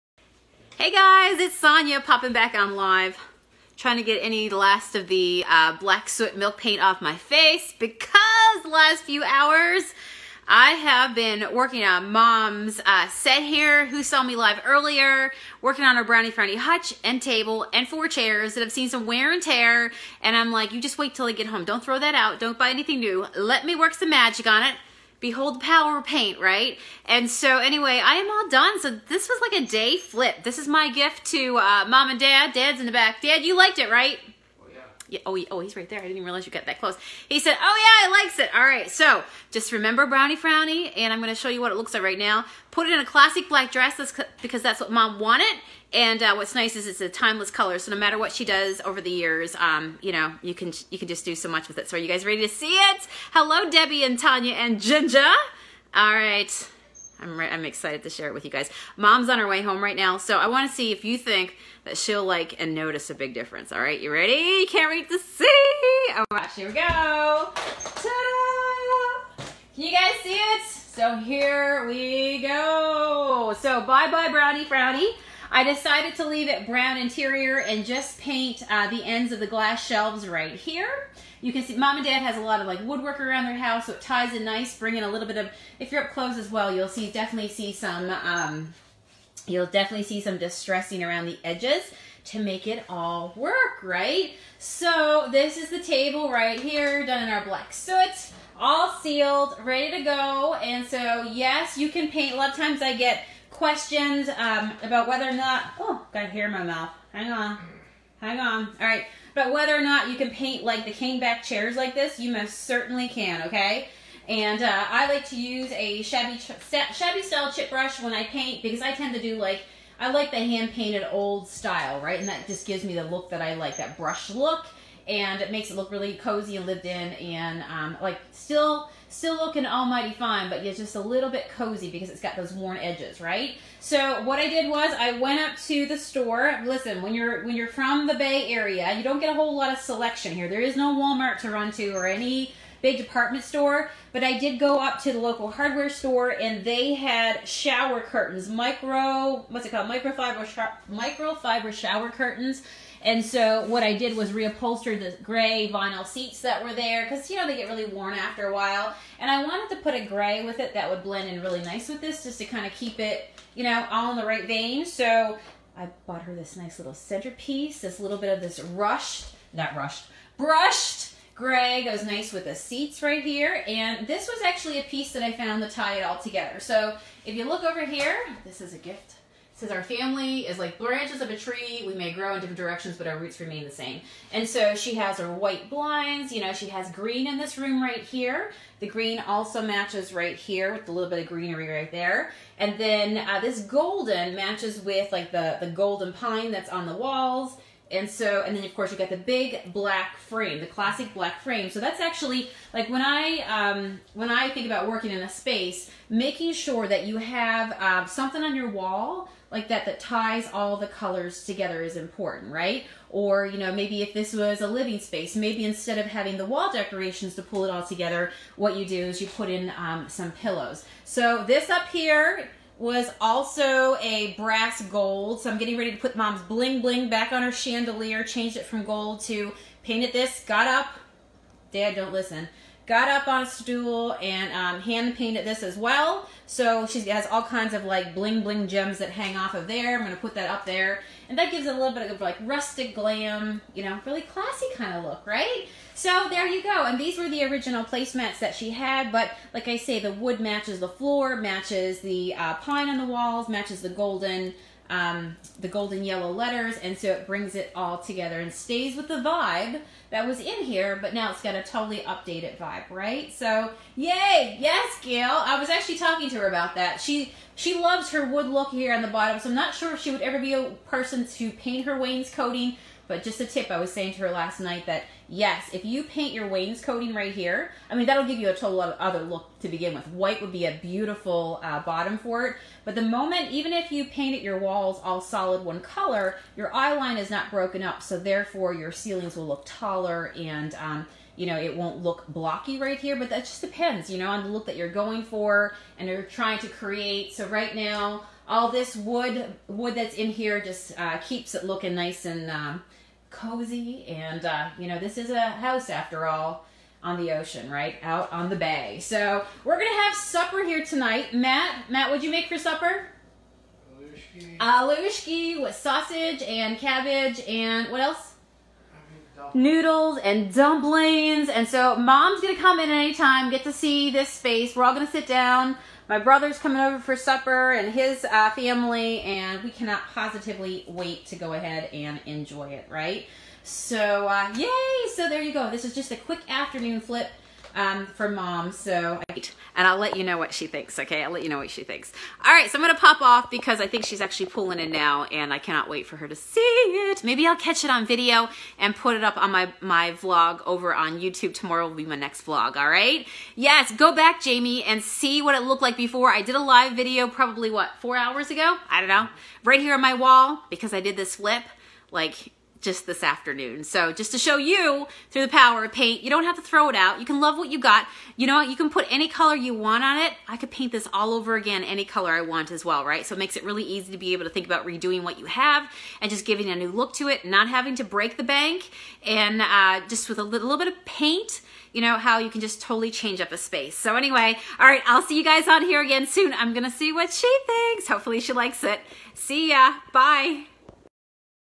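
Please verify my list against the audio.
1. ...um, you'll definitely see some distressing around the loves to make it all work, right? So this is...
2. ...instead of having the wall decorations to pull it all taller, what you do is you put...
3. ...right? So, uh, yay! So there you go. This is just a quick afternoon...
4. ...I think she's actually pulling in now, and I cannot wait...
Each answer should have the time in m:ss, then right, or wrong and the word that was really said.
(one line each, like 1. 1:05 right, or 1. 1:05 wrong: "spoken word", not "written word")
1. 1:28 wrong: "edges", not "loves"
2. 3:35 wrong: "together", not "taller"
3. 5:32 right
4. 5:43 right.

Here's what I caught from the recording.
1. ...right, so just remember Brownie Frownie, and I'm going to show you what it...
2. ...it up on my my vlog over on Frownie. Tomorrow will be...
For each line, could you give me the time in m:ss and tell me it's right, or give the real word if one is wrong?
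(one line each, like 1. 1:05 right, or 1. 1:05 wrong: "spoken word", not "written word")
1. 0:38 right
2. 5:49 wrong: "YouTube", not "Frownie".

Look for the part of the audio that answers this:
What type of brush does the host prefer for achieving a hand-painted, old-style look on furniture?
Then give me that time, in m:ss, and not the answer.
1:57.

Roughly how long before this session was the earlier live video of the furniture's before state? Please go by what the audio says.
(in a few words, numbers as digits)
4 hours.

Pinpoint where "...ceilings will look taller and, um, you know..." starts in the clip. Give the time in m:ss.
4:48.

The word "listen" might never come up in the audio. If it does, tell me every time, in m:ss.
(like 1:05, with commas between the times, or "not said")
2:16, 3:52.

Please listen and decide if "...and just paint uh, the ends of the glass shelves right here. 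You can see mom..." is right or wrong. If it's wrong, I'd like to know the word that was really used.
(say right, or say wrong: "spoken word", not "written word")
right.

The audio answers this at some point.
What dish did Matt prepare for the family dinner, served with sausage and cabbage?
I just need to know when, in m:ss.
5:14.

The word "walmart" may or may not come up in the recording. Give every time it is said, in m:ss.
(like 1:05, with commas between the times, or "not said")
2:20.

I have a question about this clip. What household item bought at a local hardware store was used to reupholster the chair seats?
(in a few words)
microfiber shower curtains.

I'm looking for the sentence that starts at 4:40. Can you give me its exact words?
White would be a beautiful uh, bottom for it.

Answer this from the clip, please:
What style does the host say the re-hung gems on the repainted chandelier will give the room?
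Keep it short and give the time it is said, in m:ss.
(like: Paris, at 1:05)
rustic glam, at 4:02.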